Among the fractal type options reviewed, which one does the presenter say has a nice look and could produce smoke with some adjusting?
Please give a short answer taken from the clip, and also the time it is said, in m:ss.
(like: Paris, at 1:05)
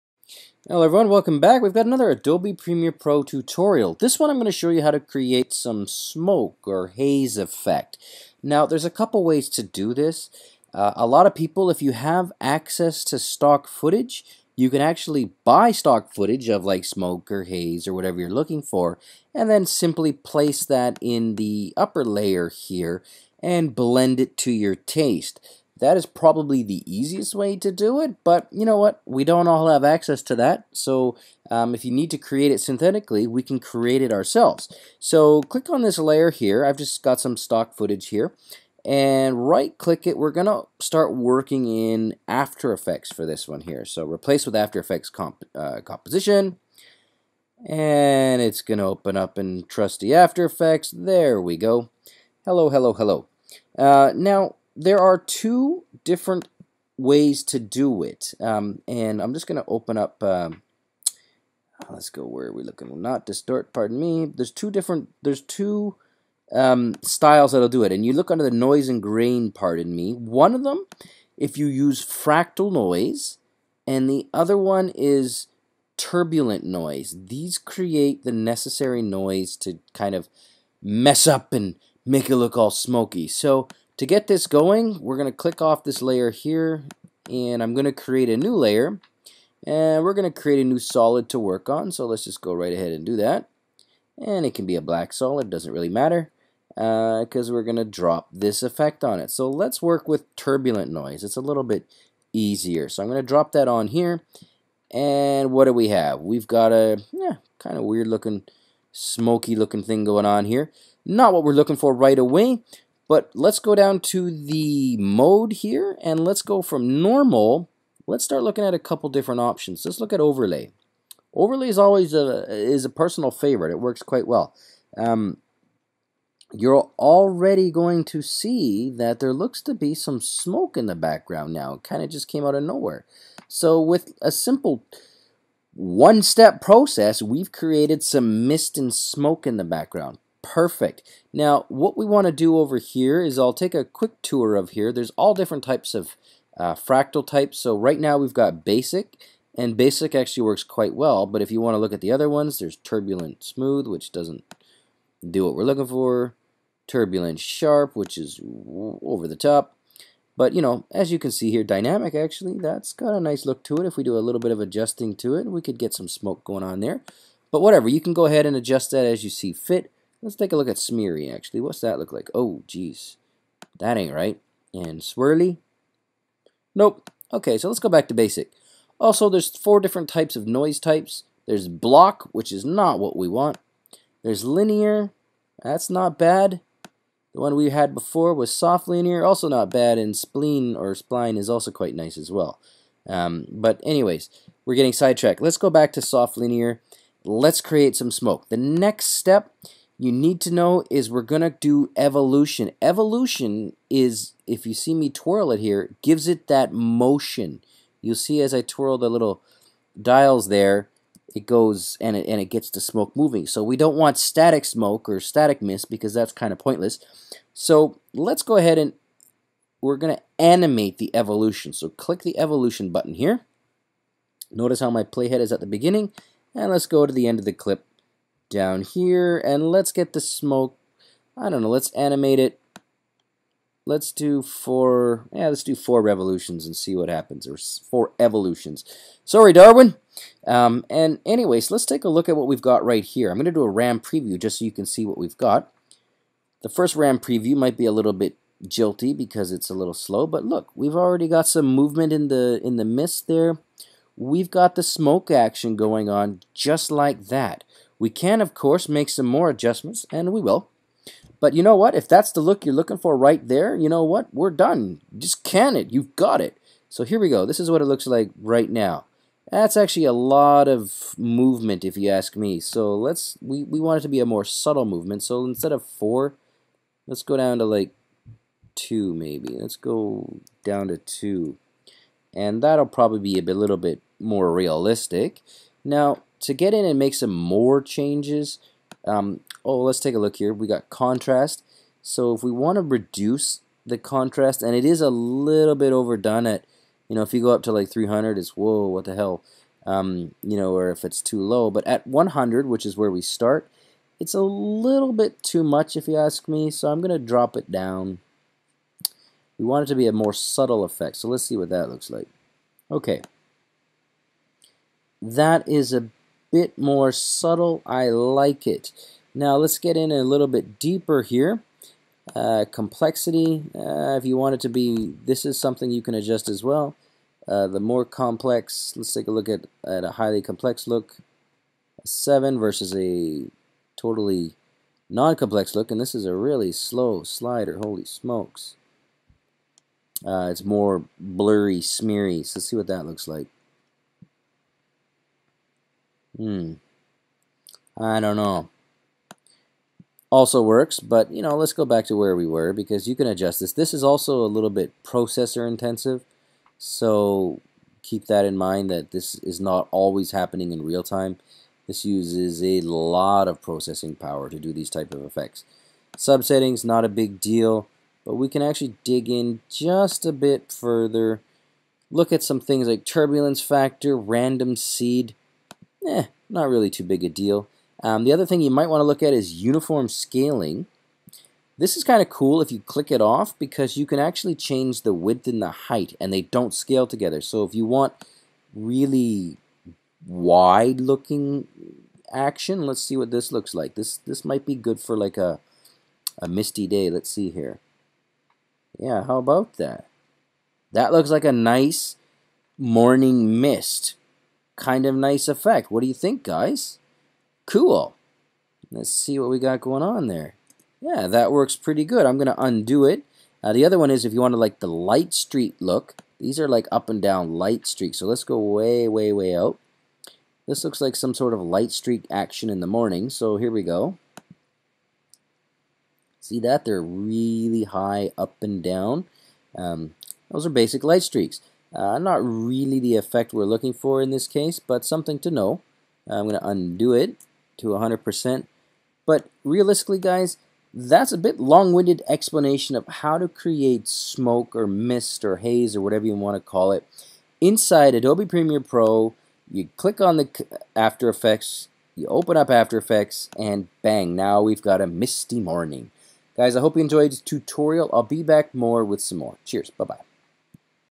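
Dynamic, at 2:41.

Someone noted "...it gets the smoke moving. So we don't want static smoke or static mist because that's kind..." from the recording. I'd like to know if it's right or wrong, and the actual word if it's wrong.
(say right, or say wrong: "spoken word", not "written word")
right.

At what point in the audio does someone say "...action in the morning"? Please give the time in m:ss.
7:02.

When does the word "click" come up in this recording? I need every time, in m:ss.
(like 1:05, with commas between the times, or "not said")
0:35, 0:39, 1:25, 3:41, 6:22, 7:29.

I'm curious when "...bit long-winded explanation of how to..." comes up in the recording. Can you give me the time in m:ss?
7:21.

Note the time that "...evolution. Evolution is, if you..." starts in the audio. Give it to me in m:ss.
3:21.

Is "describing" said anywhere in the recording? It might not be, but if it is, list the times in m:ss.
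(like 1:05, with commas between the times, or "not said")
not said.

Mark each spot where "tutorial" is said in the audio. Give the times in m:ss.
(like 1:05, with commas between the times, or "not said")
0:03, 7:37.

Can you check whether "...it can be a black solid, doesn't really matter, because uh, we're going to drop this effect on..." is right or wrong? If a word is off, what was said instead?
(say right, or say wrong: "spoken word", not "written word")
right.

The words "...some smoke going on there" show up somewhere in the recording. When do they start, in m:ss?
2:45.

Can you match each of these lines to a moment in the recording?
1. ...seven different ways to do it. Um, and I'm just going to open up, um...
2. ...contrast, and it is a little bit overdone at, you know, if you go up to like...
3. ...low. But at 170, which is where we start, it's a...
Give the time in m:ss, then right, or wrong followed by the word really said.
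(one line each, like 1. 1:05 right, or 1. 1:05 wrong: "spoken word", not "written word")
1. 0:55 wrong: "two", not "seven"
2. 4:53 right
3. 5:01 wrong: "100", not "170".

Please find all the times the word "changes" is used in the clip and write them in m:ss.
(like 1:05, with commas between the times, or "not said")
4:47, 6:24.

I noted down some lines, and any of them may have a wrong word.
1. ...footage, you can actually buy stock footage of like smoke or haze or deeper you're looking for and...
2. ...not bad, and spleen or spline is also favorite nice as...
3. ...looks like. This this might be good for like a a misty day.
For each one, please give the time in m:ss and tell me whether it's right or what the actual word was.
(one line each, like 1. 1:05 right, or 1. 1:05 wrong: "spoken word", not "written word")
1. 0:13 wrong: "whatever", not "deeper"
2. 3:09 wrong: "quite", not "favorite"
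3. 6:33 right.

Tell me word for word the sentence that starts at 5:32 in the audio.
A 7 versus a totally non-complex look, and this is a really slow slider, holy smokes.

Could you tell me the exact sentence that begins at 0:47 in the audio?
And it's going to open up in trusty After Effects.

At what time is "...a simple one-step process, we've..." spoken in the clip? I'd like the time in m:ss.
2:14.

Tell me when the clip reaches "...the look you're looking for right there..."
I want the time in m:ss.
4:22.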